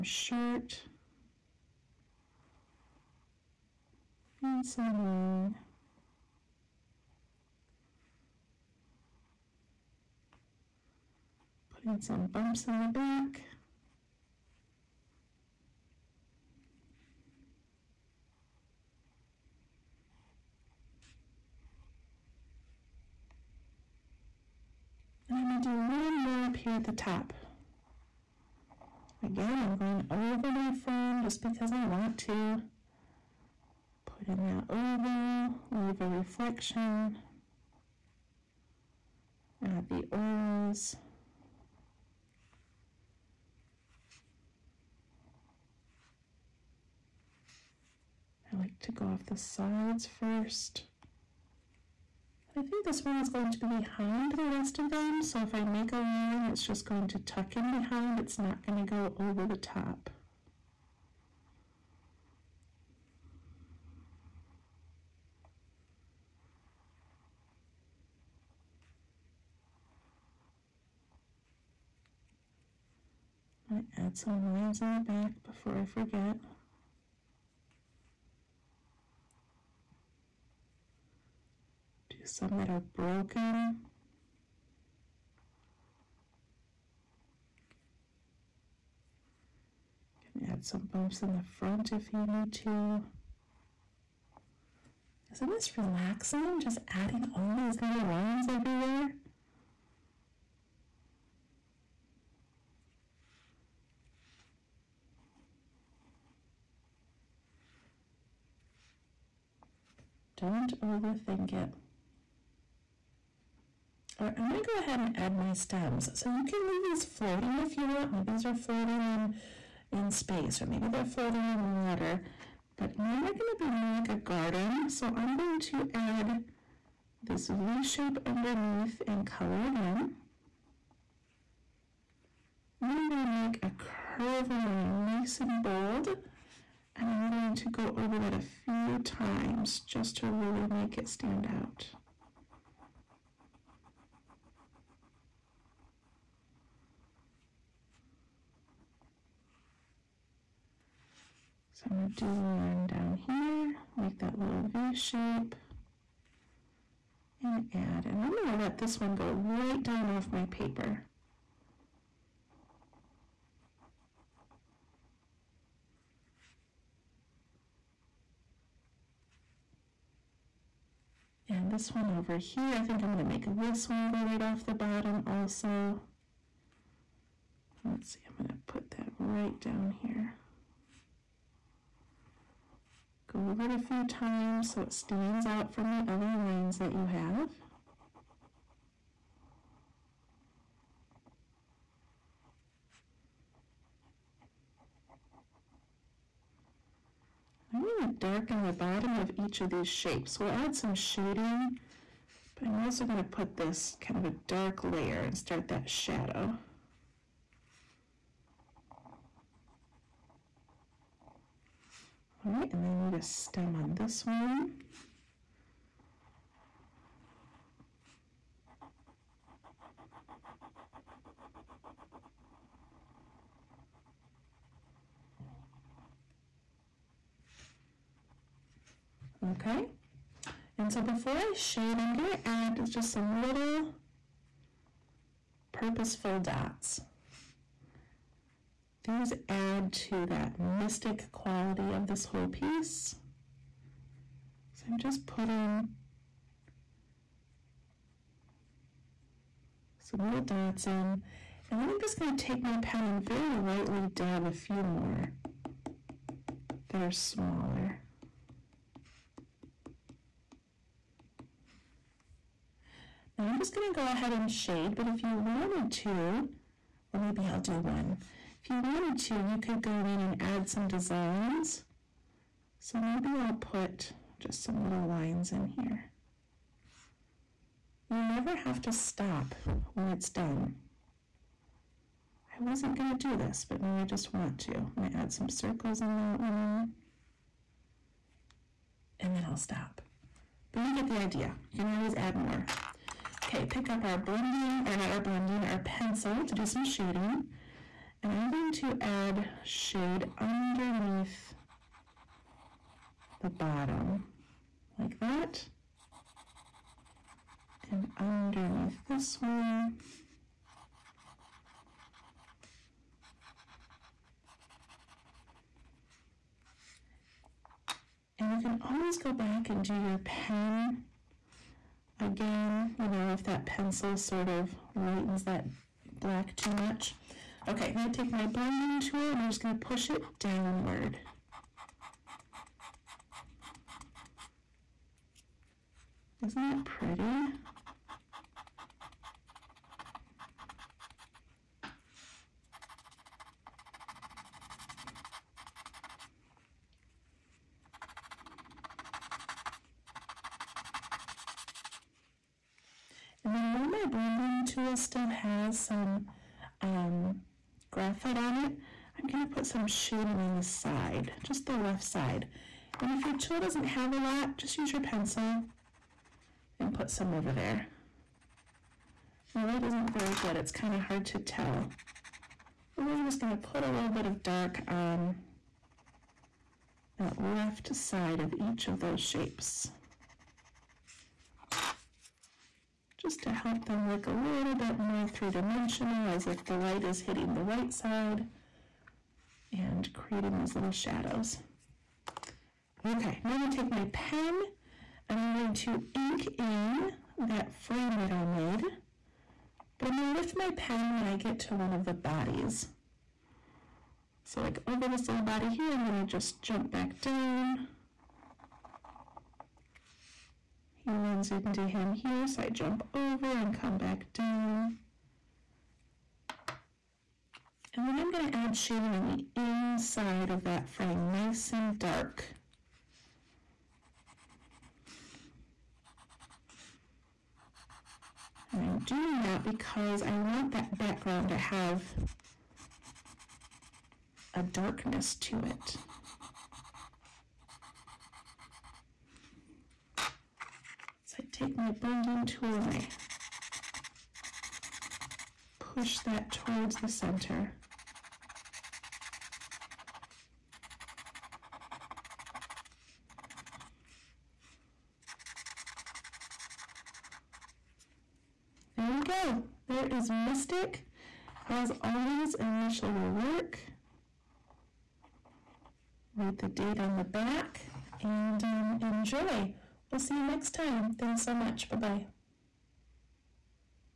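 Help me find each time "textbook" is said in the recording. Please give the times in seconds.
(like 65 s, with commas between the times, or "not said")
not said.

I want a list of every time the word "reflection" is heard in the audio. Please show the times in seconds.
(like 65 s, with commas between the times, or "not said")
36 s.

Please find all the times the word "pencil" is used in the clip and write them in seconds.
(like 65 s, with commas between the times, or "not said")
295 s, 323 s, 364 s.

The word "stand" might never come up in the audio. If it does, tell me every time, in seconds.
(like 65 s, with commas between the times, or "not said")
141 s, 184 s.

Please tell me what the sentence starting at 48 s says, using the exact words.
I like to go off the sides first.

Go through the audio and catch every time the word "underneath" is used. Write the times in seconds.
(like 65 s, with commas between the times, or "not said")
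128 s, 300 s, 308 s.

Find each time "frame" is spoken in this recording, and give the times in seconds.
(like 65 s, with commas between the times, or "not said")
30 s, 397 s, 420 s.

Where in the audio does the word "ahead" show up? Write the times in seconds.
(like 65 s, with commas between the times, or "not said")
114 s, 264 s.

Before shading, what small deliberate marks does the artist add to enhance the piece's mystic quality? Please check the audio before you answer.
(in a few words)
Purposeful dots.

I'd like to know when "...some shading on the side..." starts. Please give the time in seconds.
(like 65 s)
359 s.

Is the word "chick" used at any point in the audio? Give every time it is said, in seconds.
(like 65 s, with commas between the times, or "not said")
not said.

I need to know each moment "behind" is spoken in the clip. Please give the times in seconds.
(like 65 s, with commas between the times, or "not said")
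53 s, 57 s.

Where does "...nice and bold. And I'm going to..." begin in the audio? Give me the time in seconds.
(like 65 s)
135 s.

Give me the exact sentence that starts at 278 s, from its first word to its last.
You never have to stop when it's done.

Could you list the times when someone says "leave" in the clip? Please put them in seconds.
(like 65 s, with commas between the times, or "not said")
35 s, 116 s.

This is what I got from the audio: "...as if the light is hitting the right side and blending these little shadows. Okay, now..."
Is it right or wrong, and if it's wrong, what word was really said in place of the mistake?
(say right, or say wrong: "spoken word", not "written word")
wrong: "creating", not "blending".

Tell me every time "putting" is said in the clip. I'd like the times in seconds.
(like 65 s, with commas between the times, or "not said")
11 s, 245 s.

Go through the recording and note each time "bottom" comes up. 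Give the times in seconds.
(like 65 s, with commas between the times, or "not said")
174 s, 198 s, 303 s.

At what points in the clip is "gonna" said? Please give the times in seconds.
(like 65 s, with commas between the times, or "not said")
252 s, 263 s.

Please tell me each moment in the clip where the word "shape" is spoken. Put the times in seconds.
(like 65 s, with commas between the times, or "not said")
127 s, 154 s, 199 s, 379 s.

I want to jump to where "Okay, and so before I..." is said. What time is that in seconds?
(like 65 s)
229 s.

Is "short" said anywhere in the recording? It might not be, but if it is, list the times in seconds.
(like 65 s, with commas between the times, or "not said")
0 s.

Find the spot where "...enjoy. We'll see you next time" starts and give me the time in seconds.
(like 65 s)
468 s.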